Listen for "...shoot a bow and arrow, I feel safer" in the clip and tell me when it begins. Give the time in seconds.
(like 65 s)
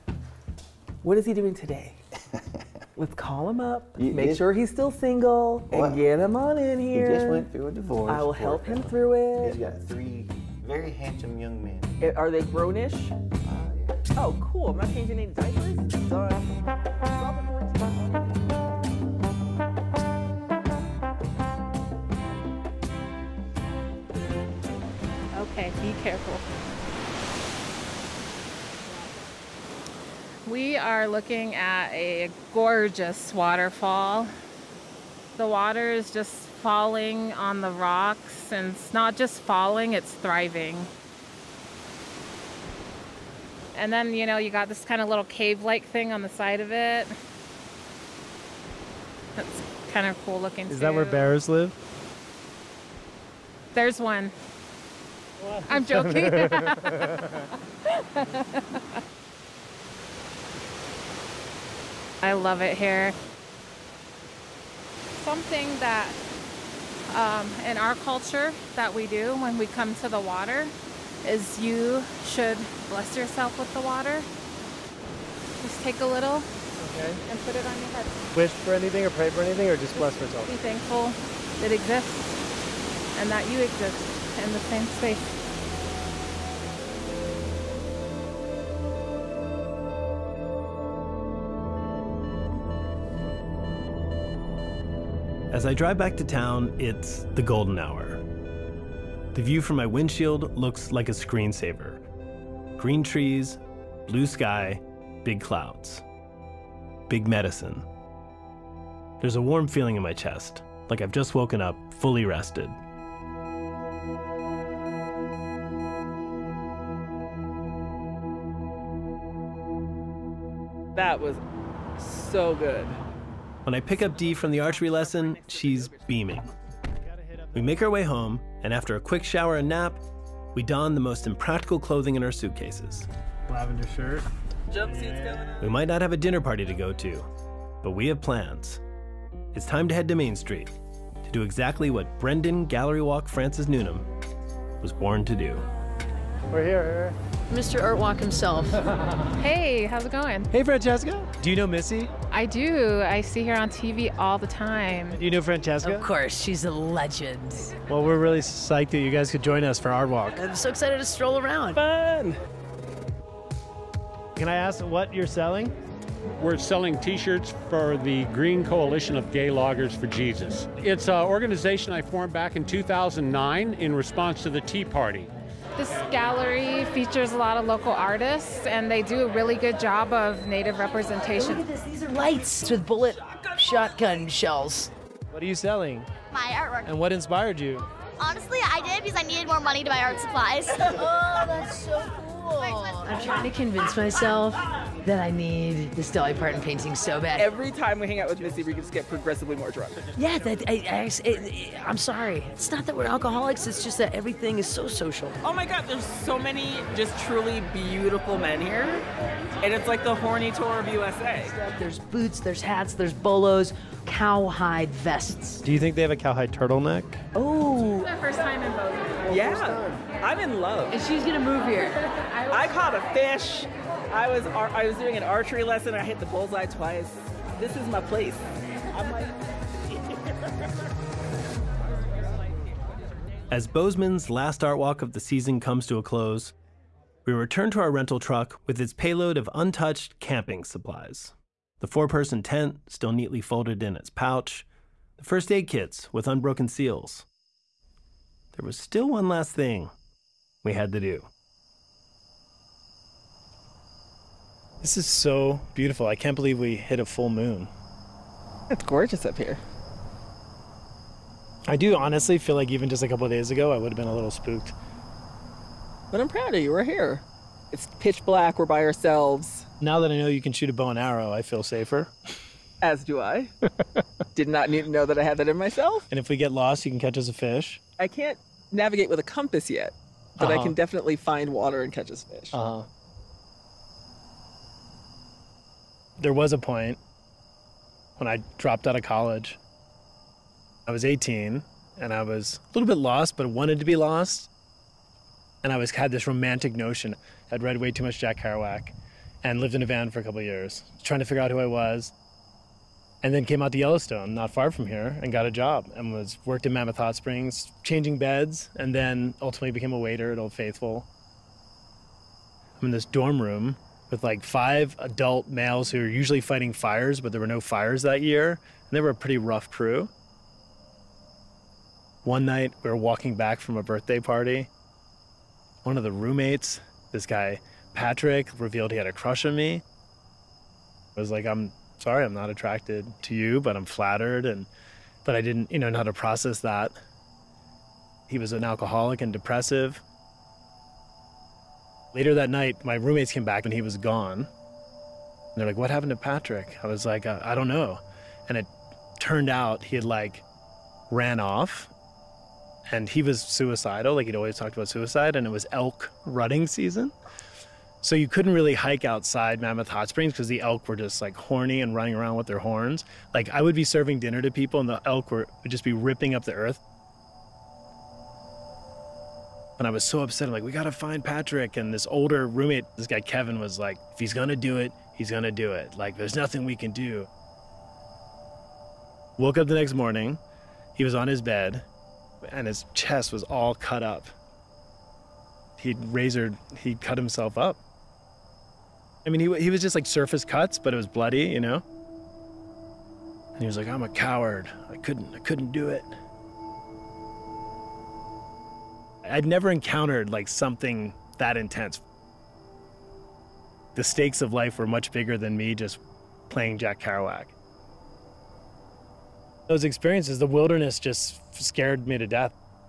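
270 s.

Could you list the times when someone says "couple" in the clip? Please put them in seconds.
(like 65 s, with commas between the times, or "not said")
263 s, 300 s.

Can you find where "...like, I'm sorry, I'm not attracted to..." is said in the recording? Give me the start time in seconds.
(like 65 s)
331 s.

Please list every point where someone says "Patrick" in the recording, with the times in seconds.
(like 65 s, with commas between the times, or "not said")
327 s, 346 s, 371 s.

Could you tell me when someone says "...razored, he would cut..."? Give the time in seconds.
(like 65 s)
385 s.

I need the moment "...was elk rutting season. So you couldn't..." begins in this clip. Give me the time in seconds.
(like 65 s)
355 s.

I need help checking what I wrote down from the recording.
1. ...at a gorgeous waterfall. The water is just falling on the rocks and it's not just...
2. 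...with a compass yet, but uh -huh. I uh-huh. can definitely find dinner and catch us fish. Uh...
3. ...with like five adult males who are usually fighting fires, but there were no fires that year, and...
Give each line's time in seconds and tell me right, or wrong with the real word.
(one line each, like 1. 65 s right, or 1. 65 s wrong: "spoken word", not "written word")
1. 31 s right
2. 279 s wrong: "water", not "dinner"
3. 314 s right.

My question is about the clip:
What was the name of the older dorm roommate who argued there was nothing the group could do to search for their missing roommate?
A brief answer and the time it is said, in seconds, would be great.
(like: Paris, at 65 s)
Kevin, at 373 s.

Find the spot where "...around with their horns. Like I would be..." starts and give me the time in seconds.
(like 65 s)
362 s.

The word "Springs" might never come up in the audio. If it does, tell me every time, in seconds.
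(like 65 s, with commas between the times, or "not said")
307 s, 360 s.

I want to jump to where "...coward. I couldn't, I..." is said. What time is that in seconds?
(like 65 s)
394 s.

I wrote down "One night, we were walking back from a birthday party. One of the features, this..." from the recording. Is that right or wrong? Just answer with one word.
wrong.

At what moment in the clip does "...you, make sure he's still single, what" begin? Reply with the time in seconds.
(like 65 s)
3 s.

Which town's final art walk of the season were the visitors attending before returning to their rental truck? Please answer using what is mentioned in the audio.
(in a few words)
Bozeman.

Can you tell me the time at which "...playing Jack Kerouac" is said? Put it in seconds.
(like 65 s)
406 s.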